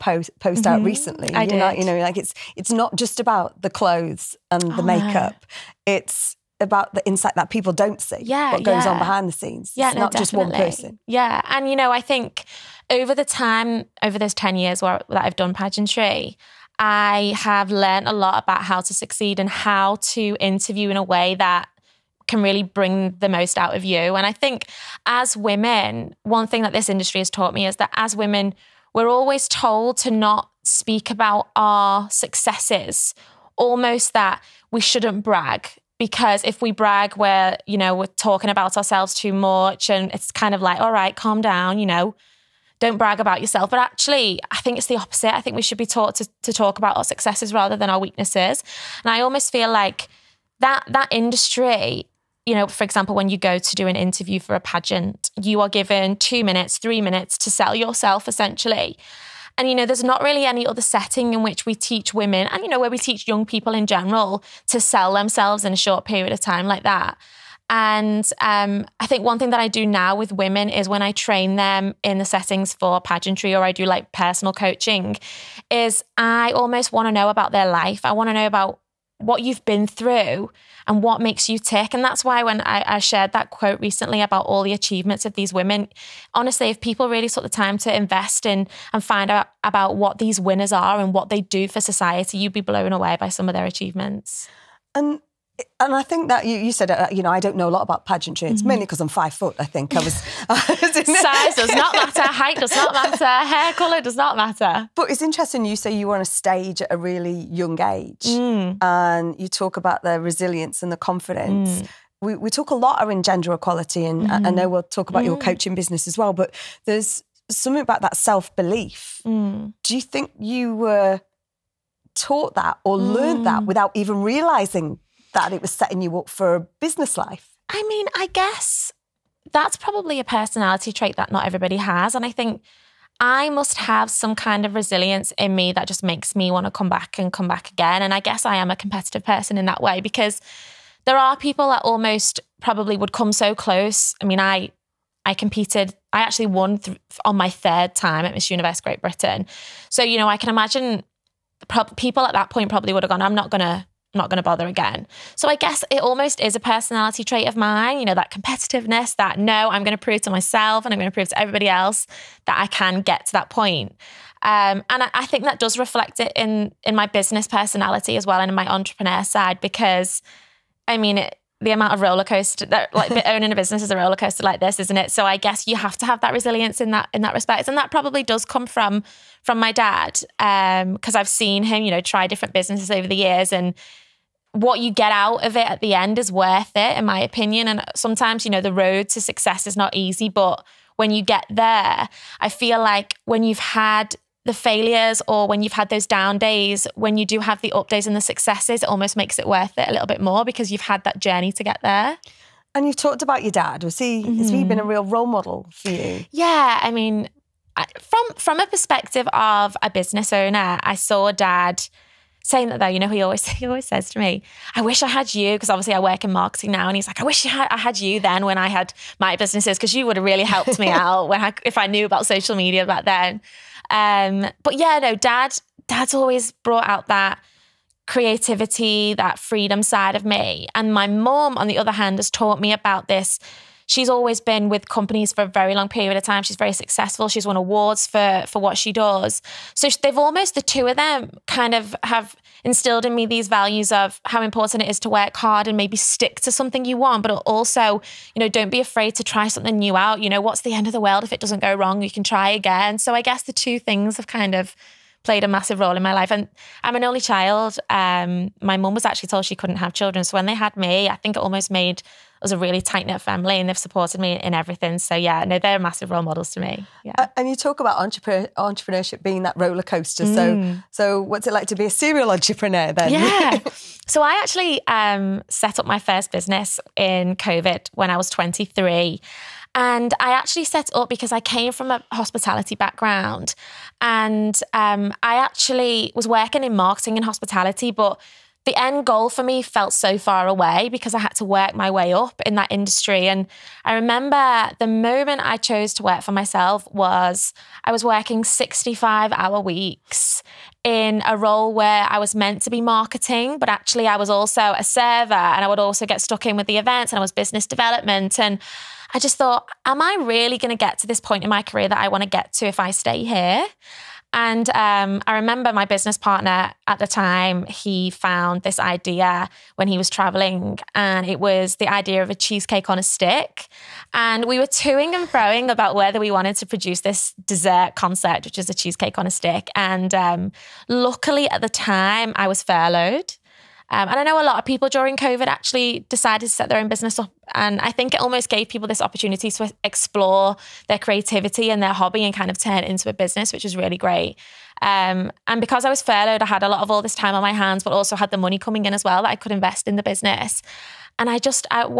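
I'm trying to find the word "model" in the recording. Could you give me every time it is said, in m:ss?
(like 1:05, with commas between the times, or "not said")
3:25, 4:26.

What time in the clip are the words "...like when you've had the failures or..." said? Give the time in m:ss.
3:12.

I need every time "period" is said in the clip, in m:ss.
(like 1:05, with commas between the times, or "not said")
1:06, 3:55.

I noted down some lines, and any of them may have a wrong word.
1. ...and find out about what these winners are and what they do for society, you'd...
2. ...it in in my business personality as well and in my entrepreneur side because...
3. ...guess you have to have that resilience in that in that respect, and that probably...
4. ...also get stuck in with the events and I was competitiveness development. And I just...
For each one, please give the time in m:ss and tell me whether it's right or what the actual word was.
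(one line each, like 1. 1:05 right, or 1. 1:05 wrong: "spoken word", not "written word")
1. 1:28 right
2. 2:46 right
3. 2:55 right
4. 5:05 wrong: "business", not "competitiveness".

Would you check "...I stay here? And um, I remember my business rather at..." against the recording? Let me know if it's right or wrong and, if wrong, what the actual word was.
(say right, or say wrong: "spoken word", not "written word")
wrong: "partner", not "rather".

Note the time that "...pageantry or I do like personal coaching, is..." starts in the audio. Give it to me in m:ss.
1:12.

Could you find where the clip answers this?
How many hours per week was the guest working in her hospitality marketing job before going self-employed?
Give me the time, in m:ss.
4:58.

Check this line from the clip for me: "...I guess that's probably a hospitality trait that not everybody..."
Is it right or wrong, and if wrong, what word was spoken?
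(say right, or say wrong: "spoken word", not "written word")
wrong: "personality", not "hospitality".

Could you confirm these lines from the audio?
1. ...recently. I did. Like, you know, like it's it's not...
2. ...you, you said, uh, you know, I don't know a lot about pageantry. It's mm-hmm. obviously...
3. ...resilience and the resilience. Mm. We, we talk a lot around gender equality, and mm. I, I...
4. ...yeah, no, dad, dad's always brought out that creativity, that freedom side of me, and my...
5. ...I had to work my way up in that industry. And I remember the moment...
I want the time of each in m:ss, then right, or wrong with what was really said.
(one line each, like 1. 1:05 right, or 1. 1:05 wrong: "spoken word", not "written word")
1. 0:00 right
2. 1:36 wrong: "mainly", not "obviously"
3. 1:50 wrong: "confidence", not "resilience"
4. 3:44 right
5. 4:51 right.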